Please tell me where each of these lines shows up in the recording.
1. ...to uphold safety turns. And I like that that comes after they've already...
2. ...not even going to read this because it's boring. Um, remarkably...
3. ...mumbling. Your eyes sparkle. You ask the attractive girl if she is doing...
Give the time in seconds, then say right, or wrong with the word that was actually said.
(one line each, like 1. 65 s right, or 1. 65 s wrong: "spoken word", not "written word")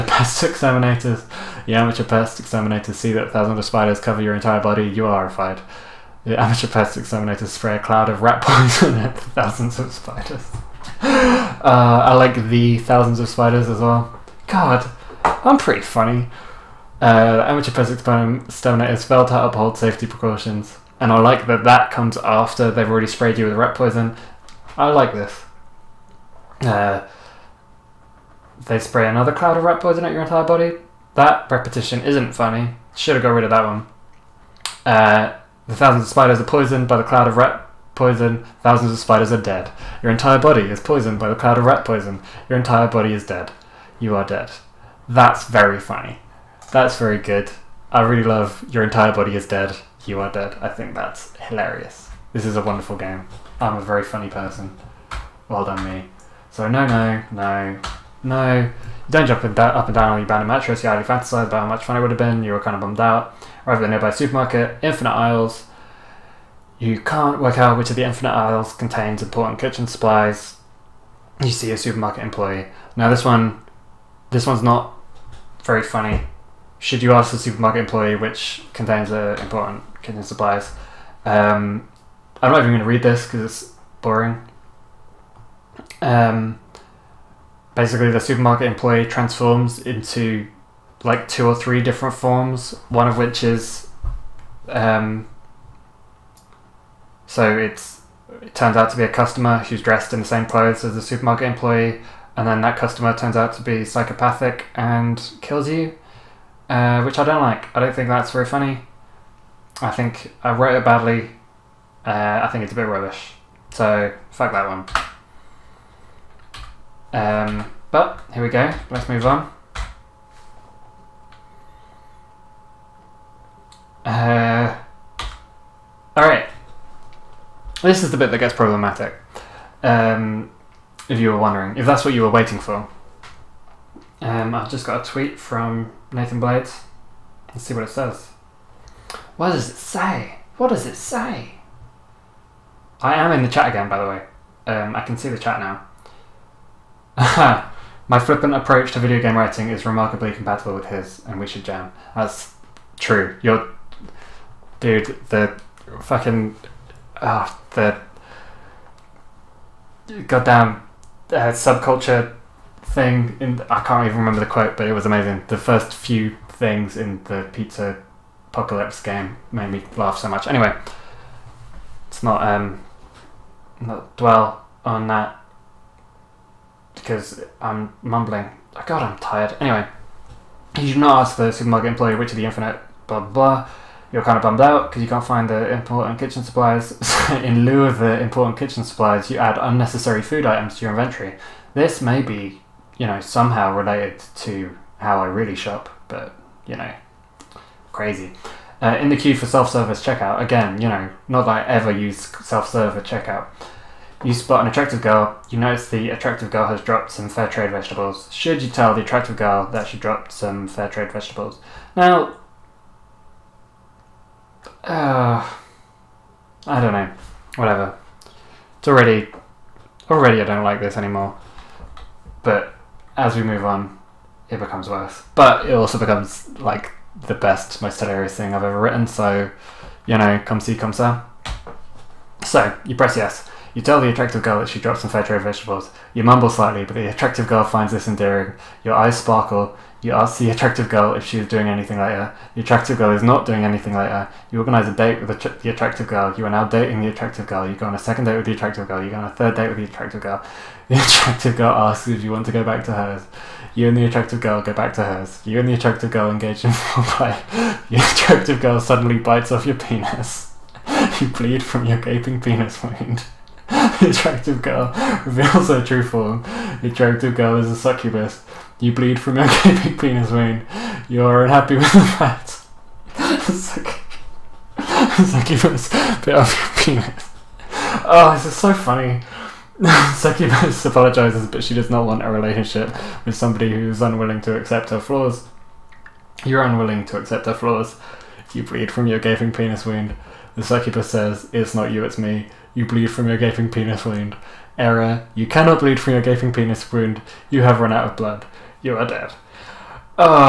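1. 19 s wrong: "precautions", not "turns"
2. 82 s wrong: "basically", not "remarkably"
3. 238 s wrong: "endearing", not "mumbling".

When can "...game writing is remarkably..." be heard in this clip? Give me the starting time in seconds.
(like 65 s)
149 s.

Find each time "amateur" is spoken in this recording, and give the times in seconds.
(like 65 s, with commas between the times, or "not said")
1 s, 6 s, 17 s.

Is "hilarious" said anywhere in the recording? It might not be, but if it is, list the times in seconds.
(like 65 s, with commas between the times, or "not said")
51 s, 227 s.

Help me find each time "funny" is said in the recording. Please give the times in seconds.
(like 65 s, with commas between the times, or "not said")
15 s, 32 s, 45 s, 54 s, 75 s, 108 s, 278 s.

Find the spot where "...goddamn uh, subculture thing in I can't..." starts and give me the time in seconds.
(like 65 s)
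160 s.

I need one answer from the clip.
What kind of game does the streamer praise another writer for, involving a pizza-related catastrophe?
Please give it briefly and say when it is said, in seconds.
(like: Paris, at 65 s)
pizza apocalypse game, at 167 s.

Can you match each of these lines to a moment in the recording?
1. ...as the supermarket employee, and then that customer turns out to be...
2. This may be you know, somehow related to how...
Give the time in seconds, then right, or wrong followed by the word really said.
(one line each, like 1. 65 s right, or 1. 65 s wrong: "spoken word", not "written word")
1. 100 s right
2. 191 s right.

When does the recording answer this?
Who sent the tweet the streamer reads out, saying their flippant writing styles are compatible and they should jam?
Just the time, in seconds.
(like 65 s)
136 s.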